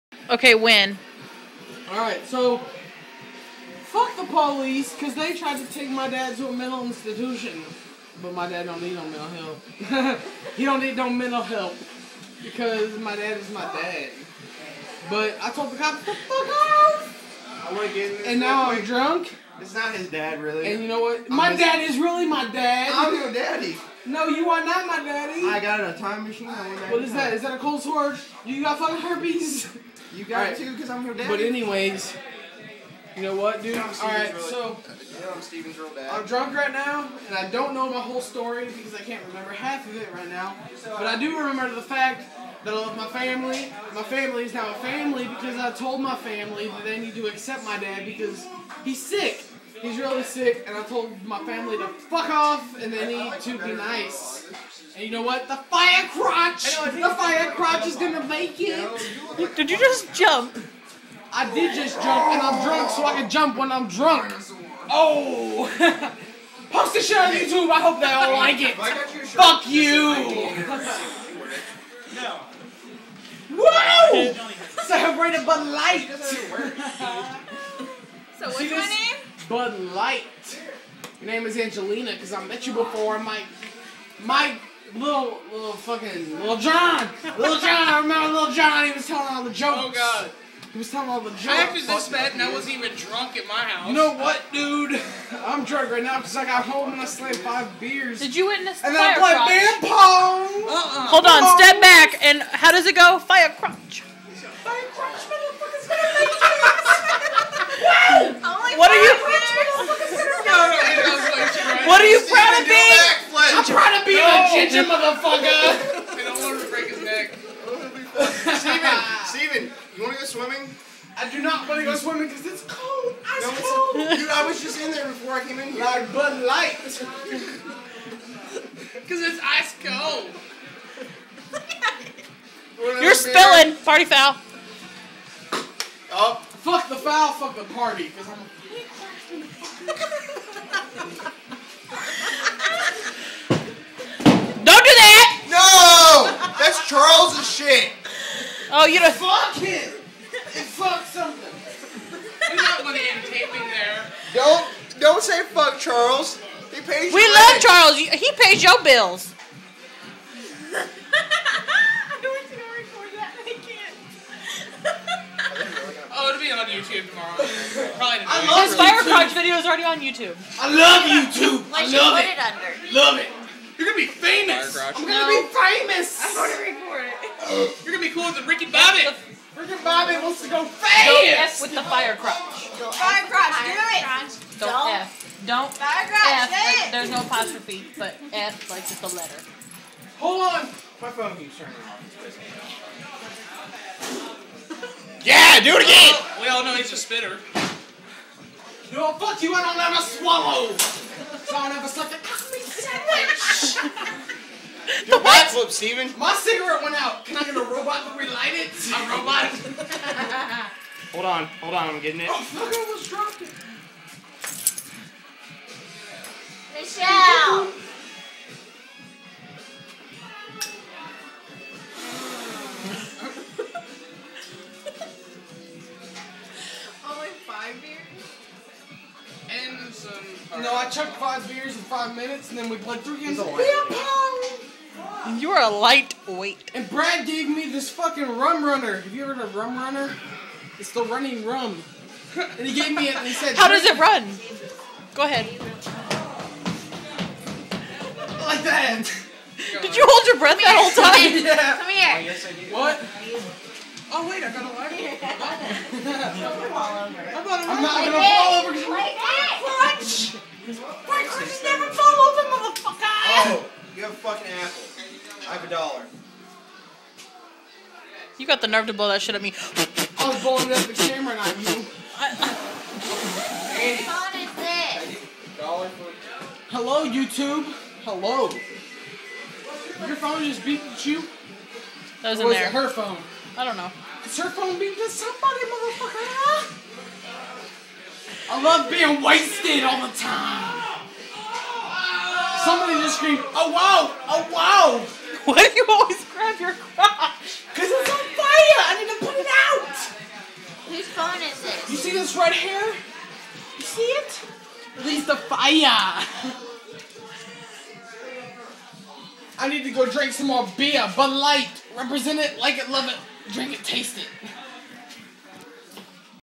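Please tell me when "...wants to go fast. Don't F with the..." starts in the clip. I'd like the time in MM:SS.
03:00.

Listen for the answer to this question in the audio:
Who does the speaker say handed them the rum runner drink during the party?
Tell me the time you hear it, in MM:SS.
03:56.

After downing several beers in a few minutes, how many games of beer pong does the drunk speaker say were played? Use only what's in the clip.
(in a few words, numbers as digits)
3.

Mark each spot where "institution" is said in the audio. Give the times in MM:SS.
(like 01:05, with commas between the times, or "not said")
00:06.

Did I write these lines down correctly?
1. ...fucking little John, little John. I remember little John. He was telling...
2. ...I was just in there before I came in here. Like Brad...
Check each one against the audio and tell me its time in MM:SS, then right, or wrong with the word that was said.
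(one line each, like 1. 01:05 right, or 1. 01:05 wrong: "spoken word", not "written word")
1. 01:25 right
2. 02:04 wrong: "Bud", not "Brad".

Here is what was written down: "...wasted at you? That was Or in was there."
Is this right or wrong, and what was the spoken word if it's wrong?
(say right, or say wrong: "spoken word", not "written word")
wrong: "beeped", not "wasted".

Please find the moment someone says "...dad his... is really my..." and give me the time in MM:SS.
00:21.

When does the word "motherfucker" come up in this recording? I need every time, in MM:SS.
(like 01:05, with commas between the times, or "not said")
01:45, 01:55, 04:22, 04:45.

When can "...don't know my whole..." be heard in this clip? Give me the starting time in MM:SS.
00:37.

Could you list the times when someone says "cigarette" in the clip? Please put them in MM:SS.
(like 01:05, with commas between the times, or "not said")
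03:26.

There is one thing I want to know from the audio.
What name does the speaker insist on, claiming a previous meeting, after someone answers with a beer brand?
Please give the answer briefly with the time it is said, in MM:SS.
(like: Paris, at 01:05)
Angelina, at 01:21.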